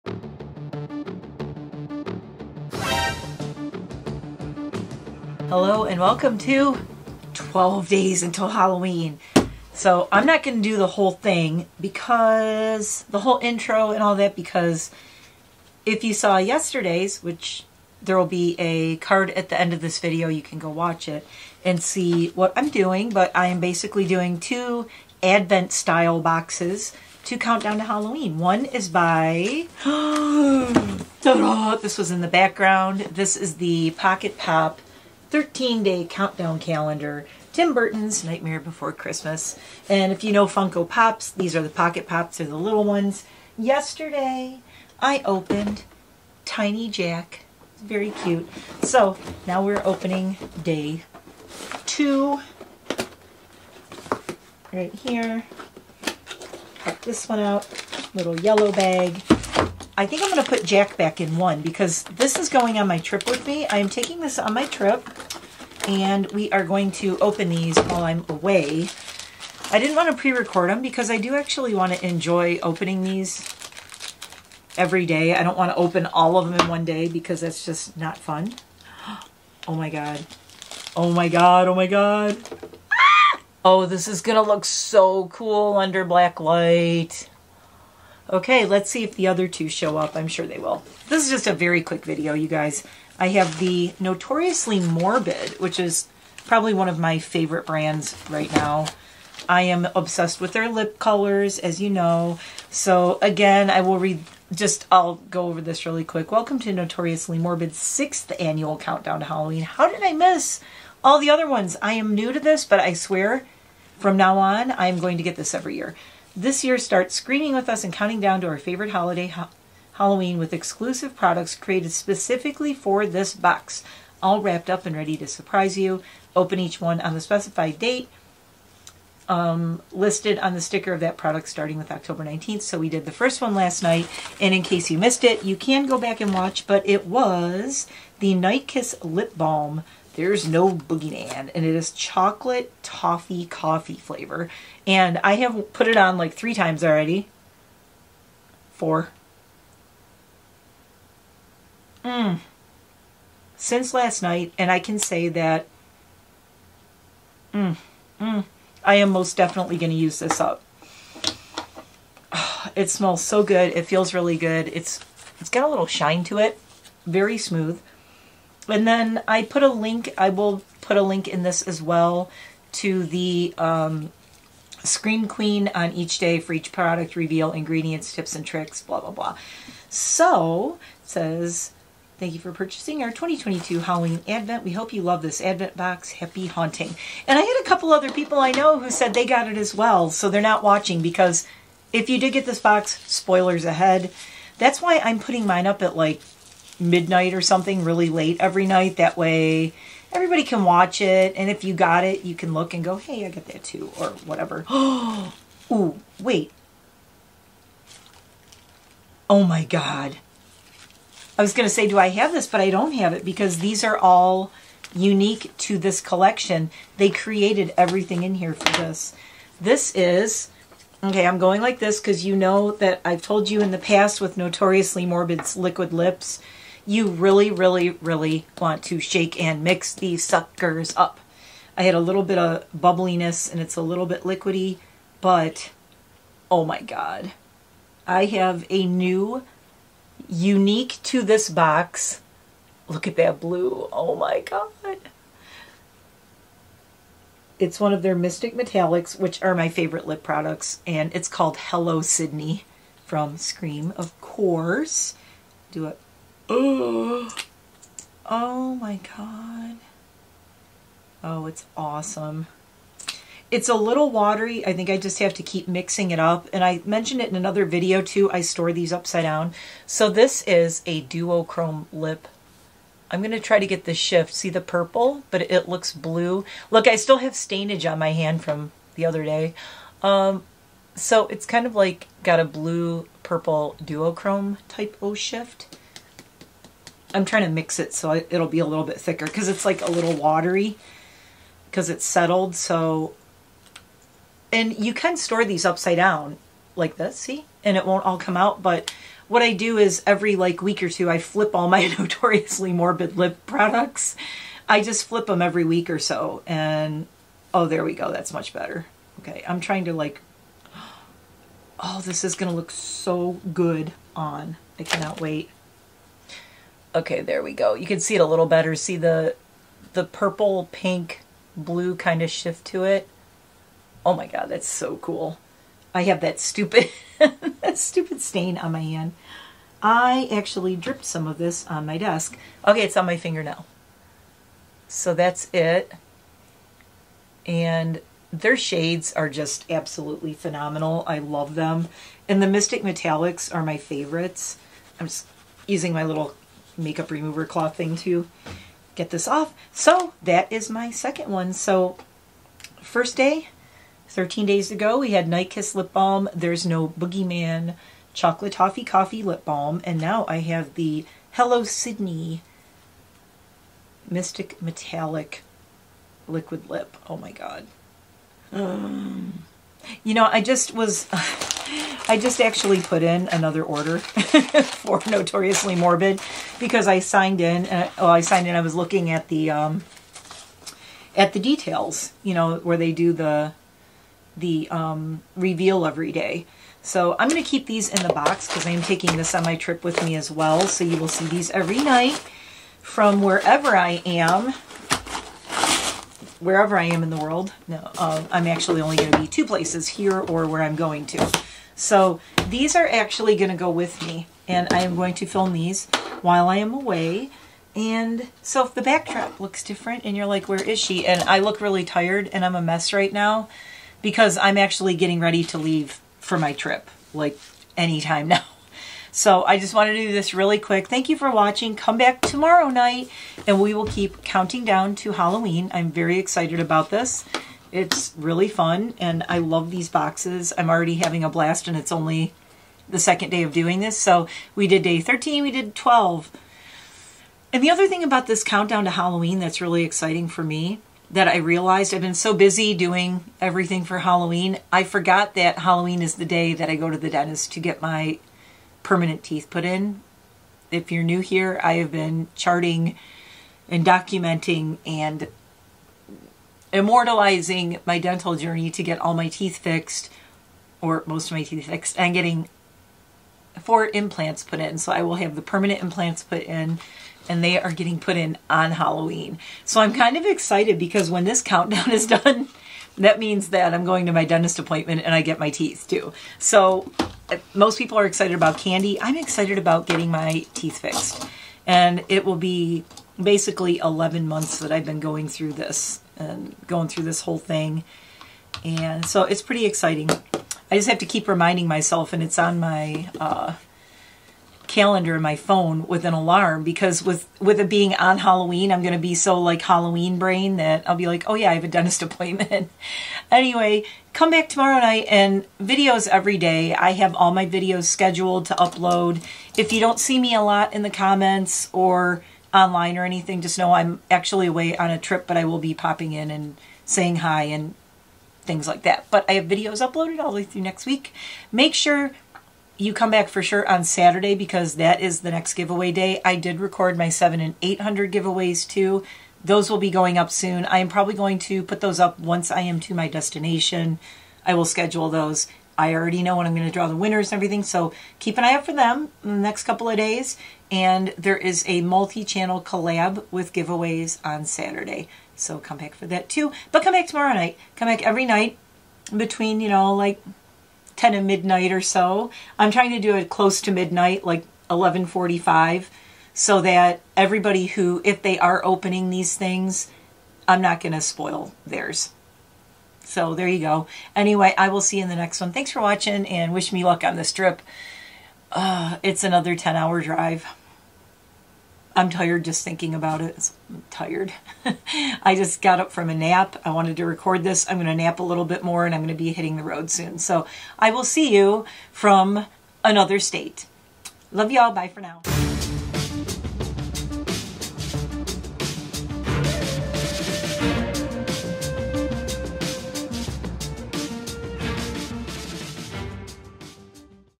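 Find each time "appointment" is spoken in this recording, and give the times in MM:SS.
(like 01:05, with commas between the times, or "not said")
07:54, 08:22.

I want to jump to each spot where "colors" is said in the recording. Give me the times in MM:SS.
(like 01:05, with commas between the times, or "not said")
01:40.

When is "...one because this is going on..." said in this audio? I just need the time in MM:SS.
01:01.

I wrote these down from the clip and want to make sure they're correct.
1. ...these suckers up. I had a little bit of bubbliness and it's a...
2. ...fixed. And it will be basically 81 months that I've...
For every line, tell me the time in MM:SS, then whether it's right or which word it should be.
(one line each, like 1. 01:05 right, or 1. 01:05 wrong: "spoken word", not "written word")
1. 03:49 right
2. 08:00 wrong: "11", not "81".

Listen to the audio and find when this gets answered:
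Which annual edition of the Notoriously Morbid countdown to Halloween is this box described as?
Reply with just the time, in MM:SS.
01:47.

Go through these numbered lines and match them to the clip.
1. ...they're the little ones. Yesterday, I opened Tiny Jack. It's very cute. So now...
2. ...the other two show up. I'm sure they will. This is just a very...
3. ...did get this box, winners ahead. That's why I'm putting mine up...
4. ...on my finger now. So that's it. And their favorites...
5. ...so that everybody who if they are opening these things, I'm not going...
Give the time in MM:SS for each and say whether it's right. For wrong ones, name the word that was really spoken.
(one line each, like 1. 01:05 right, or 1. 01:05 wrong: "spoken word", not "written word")
1. 00:42 right
2. 01:29 right
3. 03:12 wrong: "spoilers", not "winners"
4. 05:32 wrong: "shades", not "favorites"
5. 09:16 right.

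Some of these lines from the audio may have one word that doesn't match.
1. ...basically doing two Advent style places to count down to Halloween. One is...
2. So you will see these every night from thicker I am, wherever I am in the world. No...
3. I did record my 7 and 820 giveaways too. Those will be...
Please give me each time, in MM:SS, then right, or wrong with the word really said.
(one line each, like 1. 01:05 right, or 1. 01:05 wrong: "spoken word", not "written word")
1. 00:23 wrong: "boxes", not "places"
2. 06:30 wrong: "wherever", not "thicker"
3. 08:46 wrong: "800", not "820".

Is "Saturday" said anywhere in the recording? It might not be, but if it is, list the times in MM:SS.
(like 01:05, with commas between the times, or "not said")
08:43, 09:04.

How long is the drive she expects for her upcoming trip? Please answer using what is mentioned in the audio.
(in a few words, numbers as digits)
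10 hours.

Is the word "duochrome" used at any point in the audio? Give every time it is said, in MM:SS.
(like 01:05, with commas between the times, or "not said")
04:31, 04:43.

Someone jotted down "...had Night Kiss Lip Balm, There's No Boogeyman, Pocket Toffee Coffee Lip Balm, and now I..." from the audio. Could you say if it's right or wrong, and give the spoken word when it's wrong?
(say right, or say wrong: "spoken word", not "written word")
wrong: "Chocolate", not "Pocket".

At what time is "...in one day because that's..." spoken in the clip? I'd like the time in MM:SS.
01:16.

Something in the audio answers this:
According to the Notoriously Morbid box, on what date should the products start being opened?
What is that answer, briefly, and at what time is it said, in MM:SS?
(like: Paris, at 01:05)
October 19th, at 02:11.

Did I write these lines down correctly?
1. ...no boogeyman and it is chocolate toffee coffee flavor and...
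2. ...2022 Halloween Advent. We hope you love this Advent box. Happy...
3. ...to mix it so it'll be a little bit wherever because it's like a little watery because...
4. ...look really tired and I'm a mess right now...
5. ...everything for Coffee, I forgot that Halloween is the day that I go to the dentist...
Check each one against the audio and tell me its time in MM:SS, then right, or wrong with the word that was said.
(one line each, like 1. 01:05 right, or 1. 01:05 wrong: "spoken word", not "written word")
1. 02:20 right
2. 03:03 right
3. 04:47 wrong: "thicker", not "wherever"
4. 06:51 right
5. 07:23 wrong: "Halloween", not "Coffee".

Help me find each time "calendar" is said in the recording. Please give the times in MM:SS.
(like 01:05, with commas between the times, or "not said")
00:36, 08:14.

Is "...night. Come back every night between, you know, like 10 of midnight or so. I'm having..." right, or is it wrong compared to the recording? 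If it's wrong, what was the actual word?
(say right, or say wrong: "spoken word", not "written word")
wrong: "trying", not "having".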